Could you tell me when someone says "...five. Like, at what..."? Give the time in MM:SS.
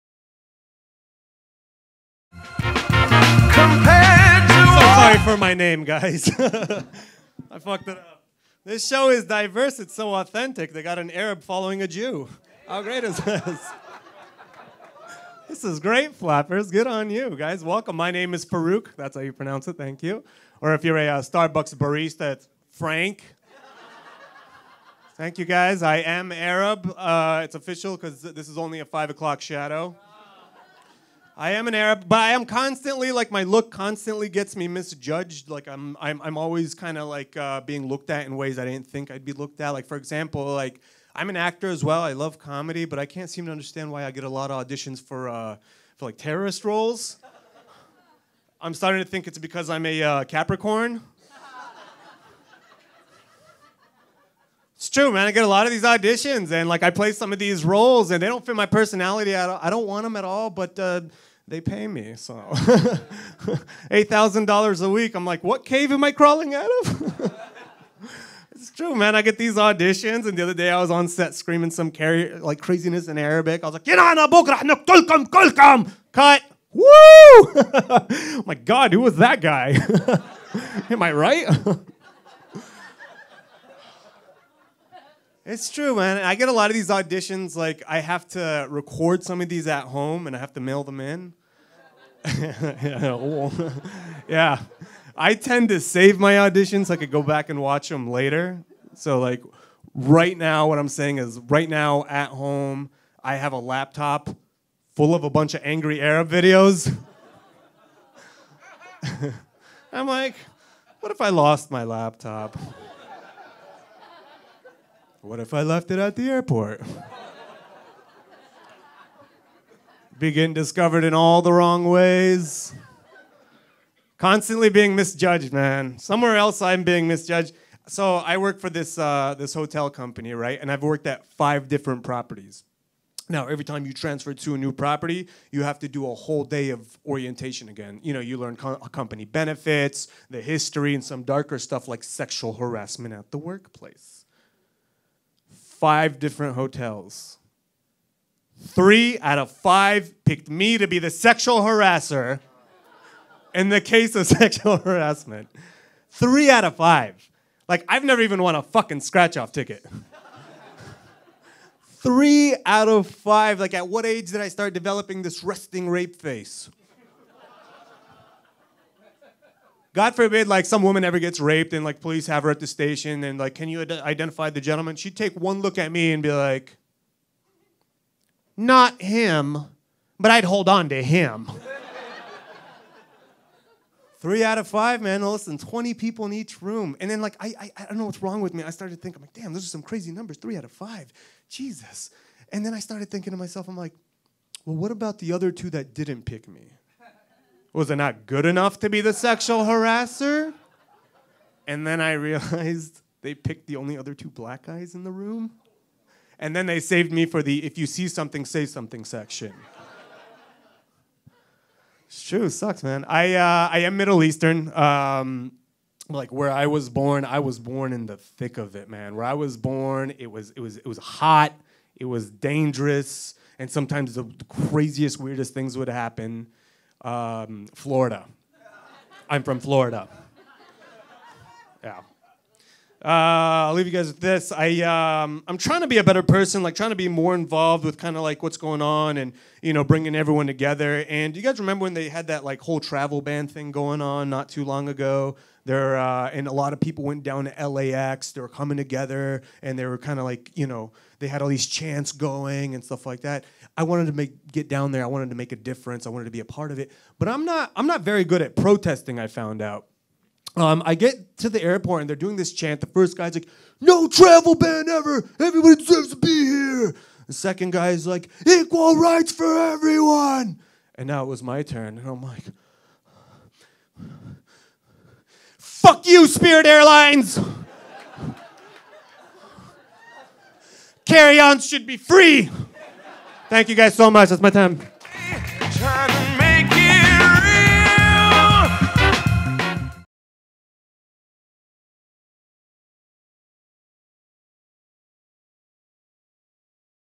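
02:43.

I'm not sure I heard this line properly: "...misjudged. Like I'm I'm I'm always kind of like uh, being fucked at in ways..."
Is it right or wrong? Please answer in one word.
wrong.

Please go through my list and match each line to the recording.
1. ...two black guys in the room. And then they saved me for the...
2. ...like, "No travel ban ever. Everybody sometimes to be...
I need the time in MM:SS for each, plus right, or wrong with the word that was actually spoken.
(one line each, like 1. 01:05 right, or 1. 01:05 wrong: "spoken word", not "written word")
1. 03:24 right
2. 04:23 wrong: "deserves", not "sometimes".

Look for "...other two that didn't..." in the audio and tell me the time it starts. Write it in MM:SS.
03:15.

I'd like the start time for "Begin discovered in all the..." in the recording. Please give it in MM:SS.
02:00.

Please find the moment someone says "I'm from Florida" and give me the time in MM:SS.
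03:49.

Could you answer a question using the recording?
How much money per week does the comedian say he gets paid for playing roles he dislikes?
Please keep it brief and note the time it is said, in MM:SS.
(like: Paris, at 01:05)
$8,000, at 01:02.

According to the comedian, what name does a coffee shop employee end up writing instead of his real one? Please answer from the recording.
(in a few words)
Frank.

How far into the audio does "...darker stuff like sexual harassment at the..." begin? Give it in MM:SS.
02:21.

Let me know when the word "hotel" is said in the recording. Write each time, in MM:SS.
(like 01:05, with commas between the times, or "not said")
02:09, 02:26.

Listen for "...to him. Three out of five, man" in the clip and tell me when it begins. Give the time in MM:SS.
03:00.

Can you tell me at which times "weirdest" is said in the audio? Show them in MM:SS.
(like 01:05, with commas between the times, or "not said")
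03:45.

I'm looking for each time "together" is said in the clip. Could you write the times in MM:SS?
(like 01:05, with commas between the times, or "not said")
04:00, 04:08.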